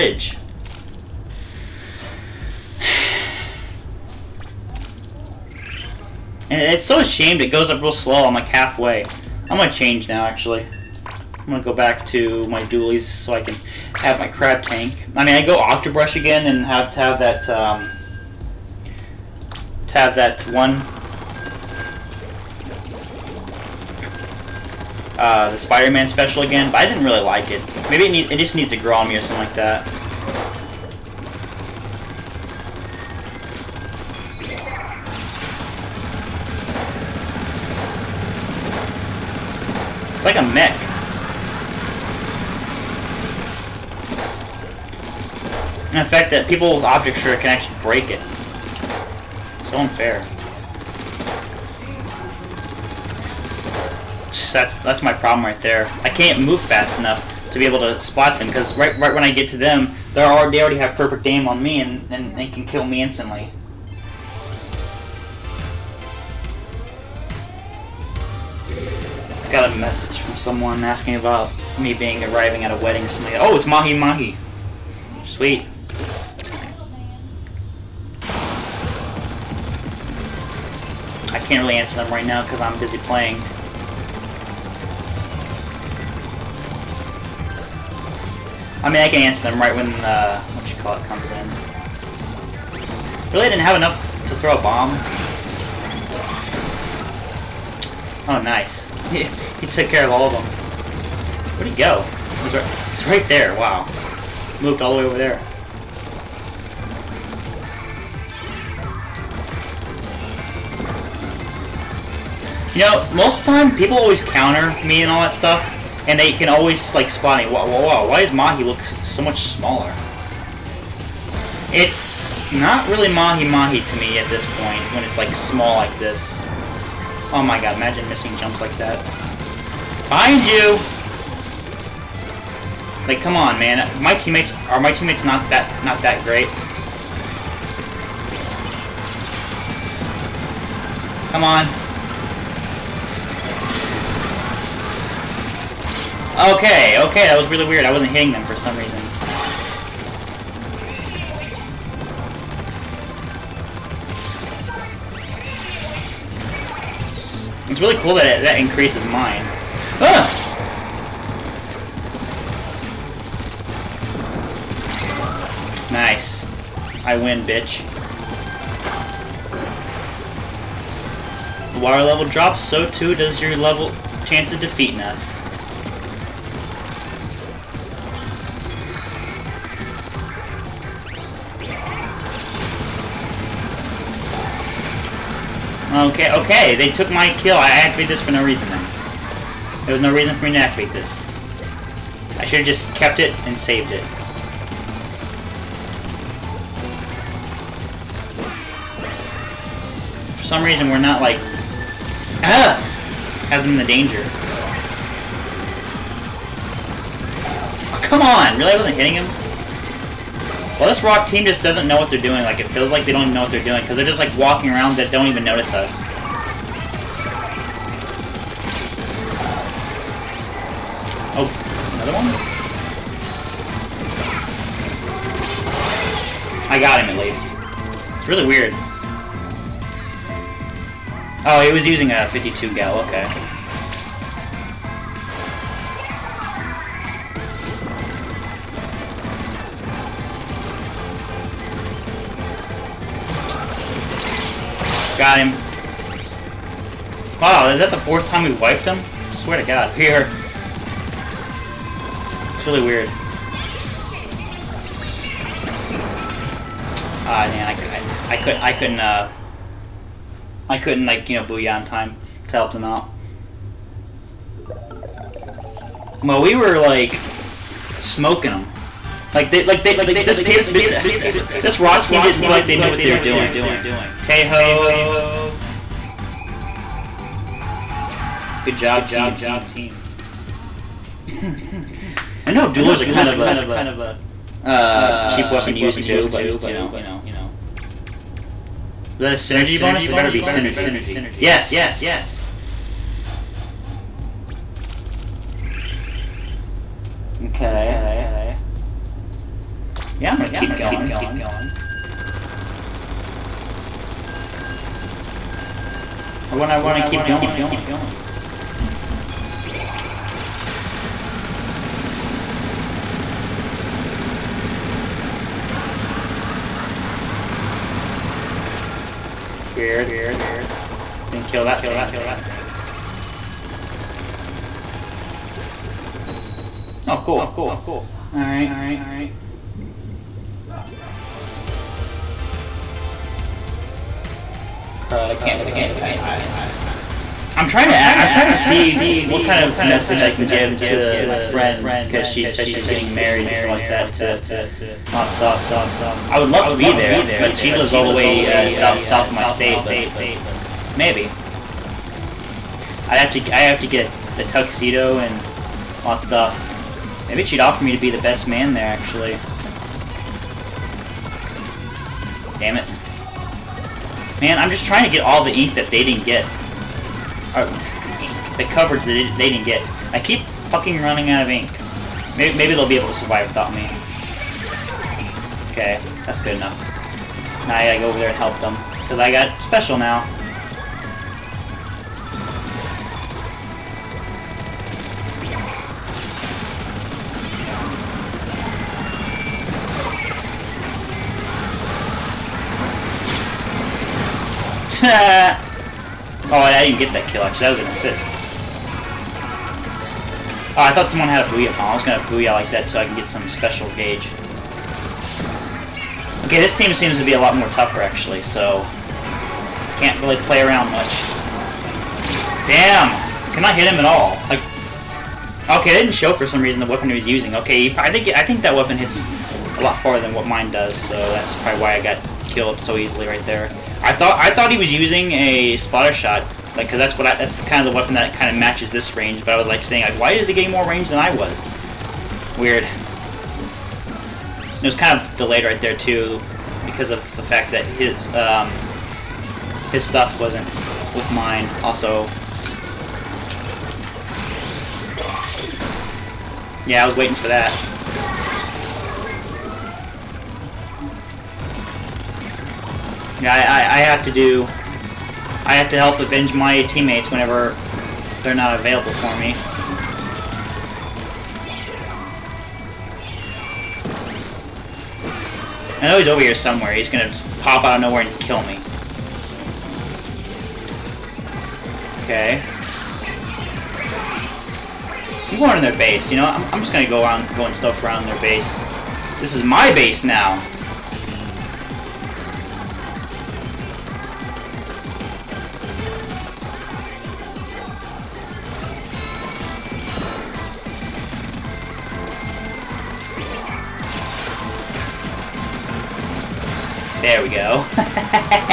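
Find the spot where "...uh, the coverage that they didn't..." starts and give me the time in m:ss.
6:07.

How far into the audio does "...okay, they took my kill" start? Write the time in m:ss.
3:06.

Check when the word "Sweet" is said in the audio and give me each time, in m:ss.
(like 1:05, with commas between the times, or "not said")
1:15.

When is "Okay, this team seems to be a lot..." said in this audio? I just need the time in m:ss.
6:46.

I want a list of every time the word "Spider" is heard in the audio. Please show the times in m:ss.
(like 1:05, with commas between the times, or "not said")
0:25.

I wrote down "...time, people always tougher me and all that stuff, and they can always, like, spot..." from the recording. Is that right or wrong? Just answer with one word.
wrong.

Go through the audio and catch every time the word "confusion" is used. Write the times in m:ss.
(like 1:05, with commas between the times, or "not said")
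not said.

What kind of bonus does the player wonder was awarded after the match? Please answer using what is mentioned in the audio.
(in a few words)
Synergy bonus.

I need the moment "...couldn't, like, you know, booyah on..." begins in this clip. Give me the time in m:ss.
4:20.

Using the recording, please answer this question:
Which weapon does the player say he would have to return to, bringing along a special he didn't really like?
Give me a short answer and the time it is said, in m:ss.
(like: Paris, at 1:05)
Octobrush, at 0:15.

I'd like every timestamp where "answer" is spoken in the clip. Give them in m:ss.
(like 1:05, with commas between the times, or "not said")
1:21, 1:29.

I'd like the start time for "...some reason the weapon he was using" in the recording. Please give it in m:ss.
6:56.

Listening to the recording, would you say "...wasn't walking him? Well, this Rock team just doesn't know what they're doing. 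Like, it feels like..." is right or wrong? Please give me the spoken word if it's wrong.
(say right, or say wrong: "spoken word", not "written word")
wrong: "hitting", not "walking".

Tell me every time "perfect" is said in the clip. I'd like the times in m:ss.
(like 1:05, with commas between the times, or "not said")
1:00.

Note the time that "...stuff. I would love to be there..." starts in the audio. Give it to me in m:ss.
5:45.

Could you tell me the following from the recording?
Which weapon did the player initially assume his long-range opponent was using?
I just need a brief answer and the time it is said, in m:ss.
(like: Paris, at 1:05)
Splattershot, at 7:05.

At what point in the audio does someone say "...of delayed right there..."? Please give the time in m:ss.
7:15.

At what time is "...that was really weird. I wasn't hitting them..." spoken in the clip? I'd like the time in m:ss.
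2:27.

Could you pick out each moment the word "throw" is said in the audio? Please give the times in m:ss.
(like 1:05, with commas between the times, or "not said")
1:34.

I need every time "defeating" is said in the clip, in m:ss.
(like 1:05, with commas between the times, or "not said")
2:54.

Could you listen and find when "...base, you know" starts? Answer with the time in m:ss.
7:55.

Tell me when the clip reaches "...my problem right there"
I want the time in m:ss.
0:55.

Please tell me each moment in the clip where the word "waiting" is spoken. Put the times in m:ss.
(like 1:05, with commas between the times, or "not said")
7:27.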